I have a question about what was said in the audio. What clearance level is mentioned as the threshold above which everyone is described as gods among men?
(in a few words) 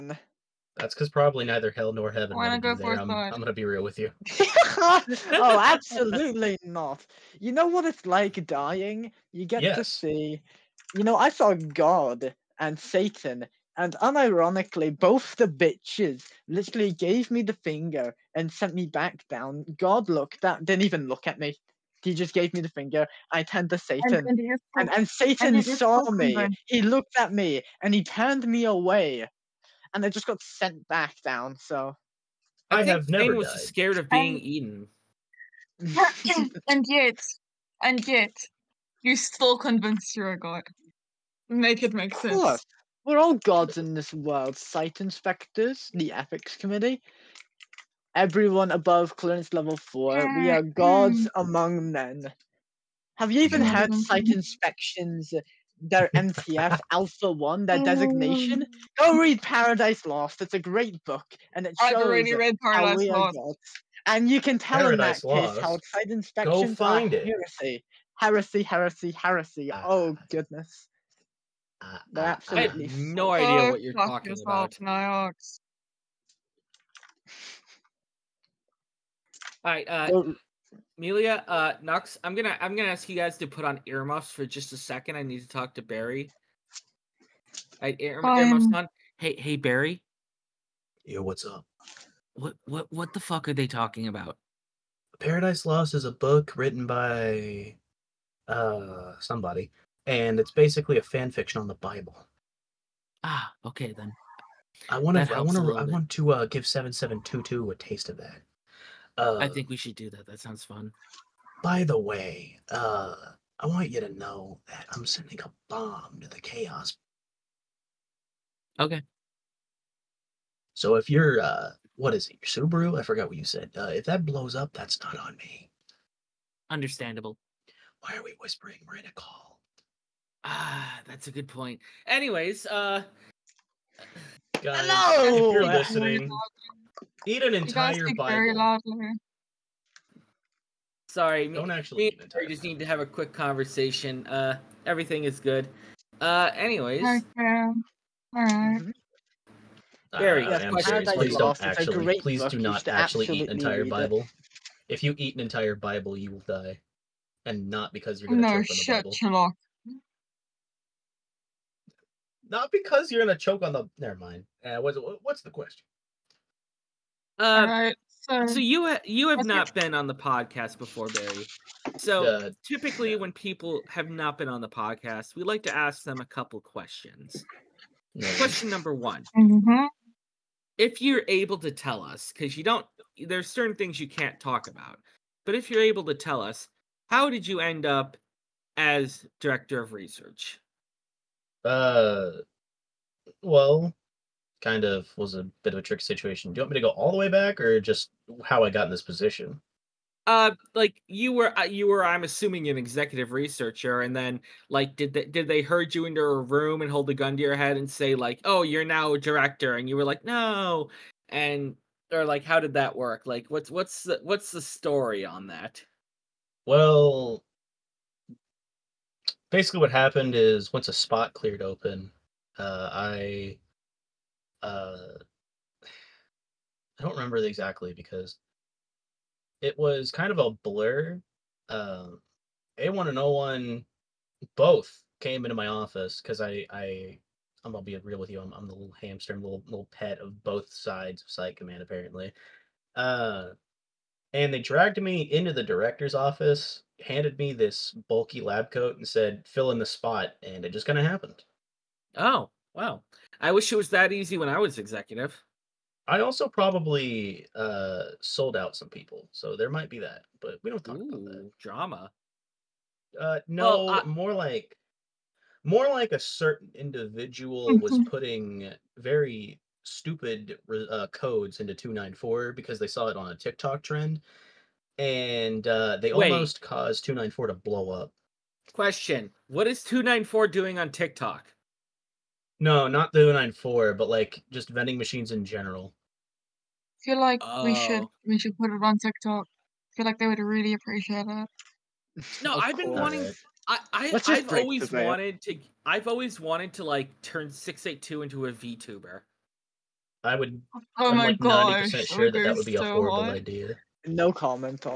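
Level four.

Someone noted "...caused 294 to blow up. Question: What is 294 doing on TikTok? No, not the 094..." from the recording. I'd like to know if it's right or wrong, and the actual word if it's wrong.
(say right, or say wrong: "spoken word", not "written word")
right.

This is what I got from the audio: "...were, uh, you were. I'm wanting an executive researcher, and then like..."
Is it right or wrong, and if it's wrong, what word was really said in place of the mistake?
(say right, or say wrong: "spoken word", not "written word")
wrong: "assuming", not "wanting".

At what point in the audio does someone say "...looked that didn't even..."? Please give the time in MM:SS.
00:20.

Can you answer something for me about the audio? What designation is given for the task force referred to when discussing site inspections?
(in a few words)
MTF Alpha One.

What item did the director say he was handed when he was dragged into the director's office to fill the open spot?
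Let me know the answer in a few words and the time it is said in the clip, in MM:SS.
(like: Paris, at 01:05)
Bulky lab coat, at 04:08.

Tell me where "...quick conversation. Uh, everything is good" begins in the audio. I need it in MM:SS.
02:23.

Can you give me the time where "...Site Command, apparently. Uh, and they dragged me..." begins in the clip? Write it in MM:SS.
04:01.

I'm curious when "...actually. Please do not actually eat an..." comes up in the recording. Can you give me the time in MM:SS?
02:31.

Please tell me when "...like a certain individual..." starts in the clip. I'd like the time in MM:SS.
04:25.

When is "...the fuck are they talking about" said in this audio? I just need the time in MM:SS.
01:33.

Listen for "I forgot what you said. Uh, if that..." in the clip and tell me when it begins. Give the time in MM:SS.
02:02.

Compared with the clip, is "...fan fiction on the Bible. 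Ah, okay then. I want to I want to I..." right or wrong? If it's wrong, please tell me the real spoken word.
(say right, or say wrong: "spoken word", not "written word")
right.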